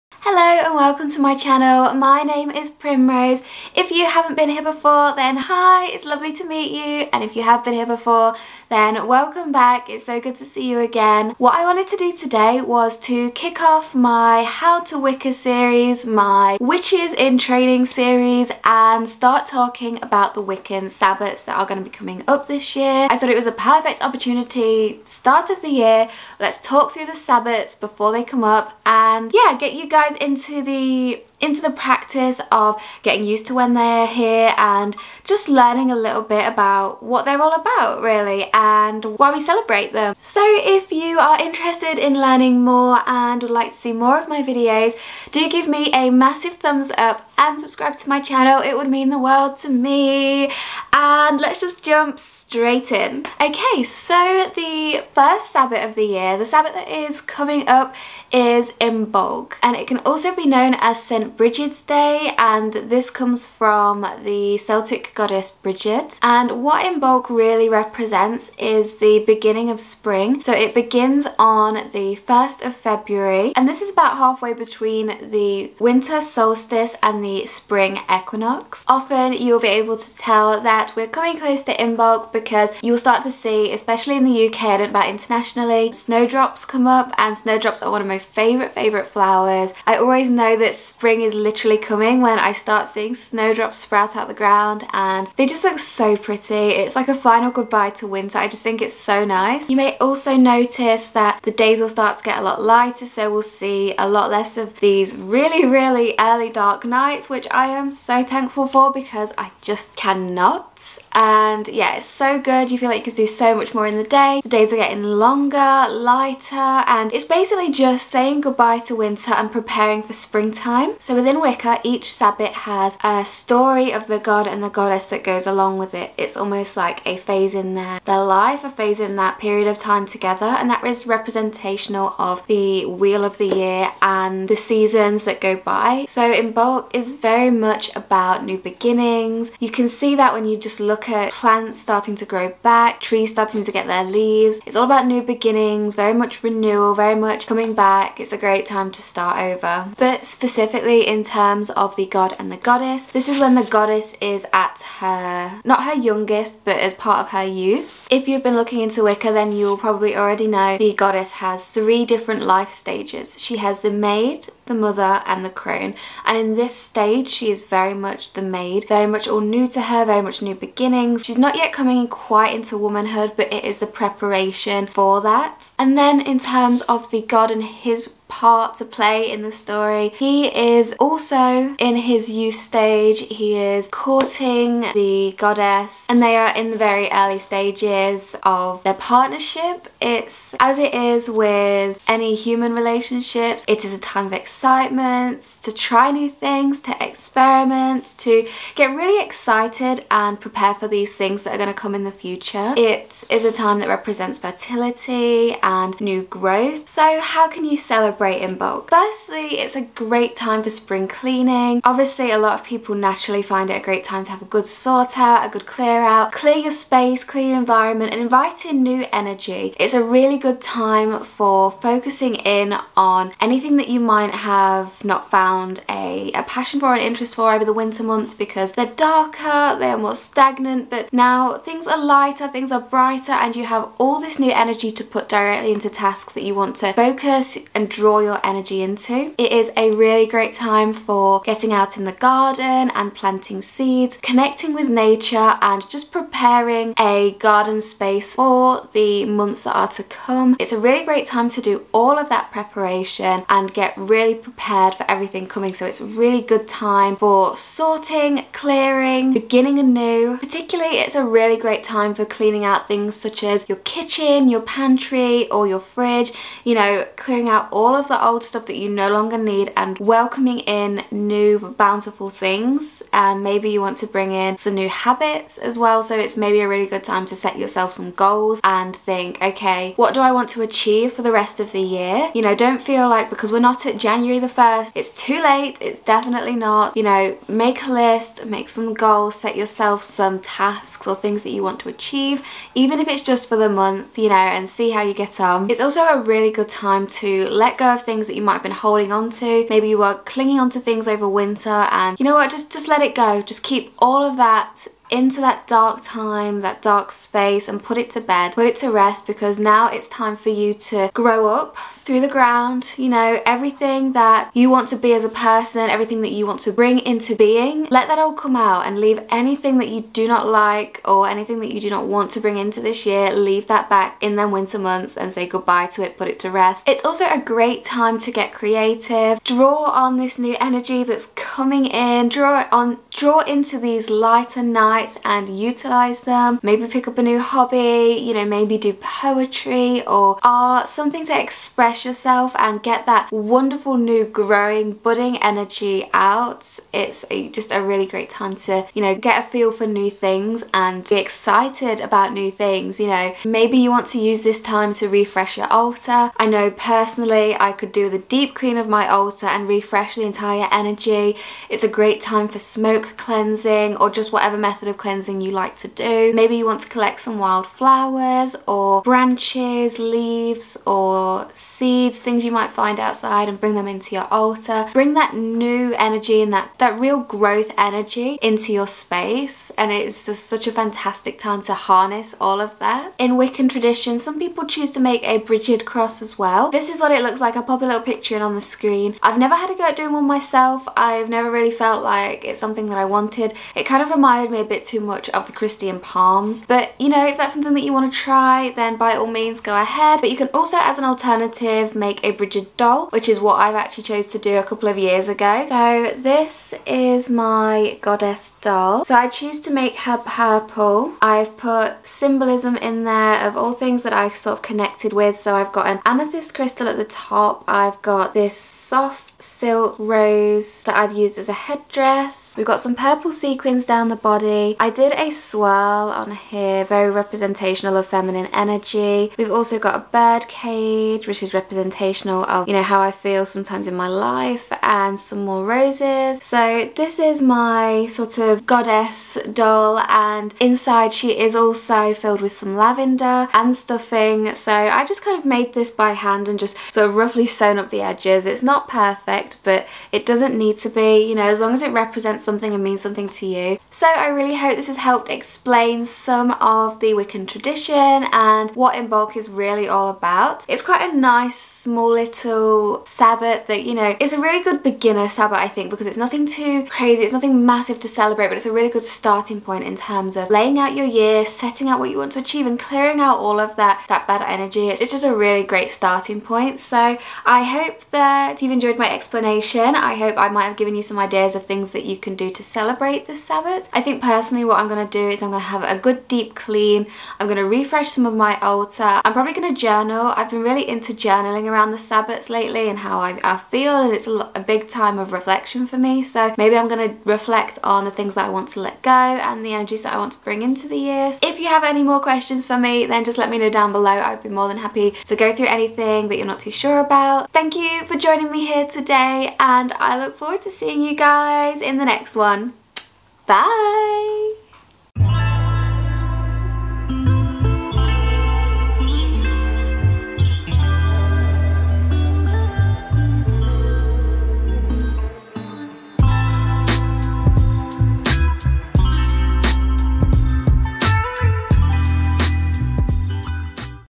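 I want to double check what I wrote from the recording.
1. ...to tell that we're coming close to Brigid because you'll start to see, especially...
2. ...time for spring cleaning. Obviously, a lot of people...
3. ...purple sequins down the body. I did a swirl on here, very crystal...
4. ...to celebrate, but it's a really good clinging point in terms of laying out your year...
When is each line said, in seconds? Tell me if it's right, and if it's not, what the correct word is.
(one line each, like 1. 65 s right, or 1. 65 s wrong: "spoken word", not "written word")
1. 79 s wrong: "Imbolc", not "Brigid"
2. 210 s right
3. 422 s wrong: "representational", not "crystal"
4. 468 s wrong: "starting", not "clinging".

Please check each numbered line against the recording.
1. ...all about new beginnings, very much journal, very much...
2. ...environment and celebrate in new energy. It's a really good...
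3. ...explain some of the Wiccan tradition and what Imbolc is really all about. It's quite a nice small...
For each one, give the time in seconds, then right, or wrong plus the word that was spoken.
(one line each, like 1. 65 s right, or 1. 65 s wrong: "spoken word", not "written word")
1. 144 s wrong: "renewal", not "journal"
2. 217 s wrong: "invite", not "celebrate"
3. 455 s right.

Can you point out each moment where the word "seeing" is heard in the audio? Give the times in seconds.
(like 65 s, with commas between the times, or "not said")
92 s, 510 s.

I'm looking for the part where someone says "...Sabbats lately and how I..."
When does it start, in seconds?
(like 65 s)
491 s.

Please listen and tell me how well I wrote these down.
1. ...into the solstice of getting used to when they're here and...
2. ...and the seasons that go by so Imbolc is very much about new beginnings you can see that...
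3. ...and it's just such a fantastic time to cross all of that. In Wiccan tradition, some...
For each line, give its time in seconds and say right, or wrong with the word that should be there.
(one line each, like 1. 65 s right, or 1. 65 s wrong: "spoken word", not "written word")
1. 31 s wrong: "practice", not "solstice"
2. 134 s right
3. 379 s wrong: "harness", not "cross".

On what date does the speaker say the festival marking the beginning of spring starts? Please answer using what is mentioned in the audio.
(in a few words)
1st of February.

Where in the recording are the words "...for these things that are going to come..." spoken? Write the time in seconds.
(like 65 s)
200 s.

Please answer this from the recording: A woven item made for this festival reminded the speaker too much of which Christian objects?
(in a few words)
Palms.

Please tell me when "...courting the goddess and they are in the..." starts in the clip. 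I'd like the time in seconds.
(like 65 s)
183 s.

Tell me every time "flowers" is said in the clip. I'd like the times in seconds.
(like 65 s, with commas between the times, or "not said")
89 s, 367 s.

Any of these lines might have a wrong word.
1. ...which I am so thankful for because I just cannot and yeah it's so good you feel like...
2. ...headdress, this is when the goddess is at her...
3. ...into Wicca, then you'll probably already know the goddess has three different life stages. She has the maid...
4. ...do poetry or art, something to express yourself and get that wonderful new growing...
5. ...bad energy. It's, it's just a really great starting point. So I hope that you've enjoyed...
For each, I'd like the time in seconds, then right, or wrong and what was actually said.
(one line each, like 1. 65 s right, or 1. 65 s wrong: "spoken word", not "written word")
1. 107 s right
2. 152 s wrong: "goddess", not "headdress"
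3. 158 s right
4. 338 s right
5. 474 s right.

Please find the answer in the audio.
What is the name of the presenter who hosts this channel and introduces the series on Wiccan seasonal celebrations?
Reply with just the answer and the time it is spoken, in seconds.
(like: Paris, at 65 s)
Primrose, at 2 s.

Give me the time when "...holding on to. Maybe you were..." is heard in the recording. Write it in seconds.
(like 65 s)
298 s.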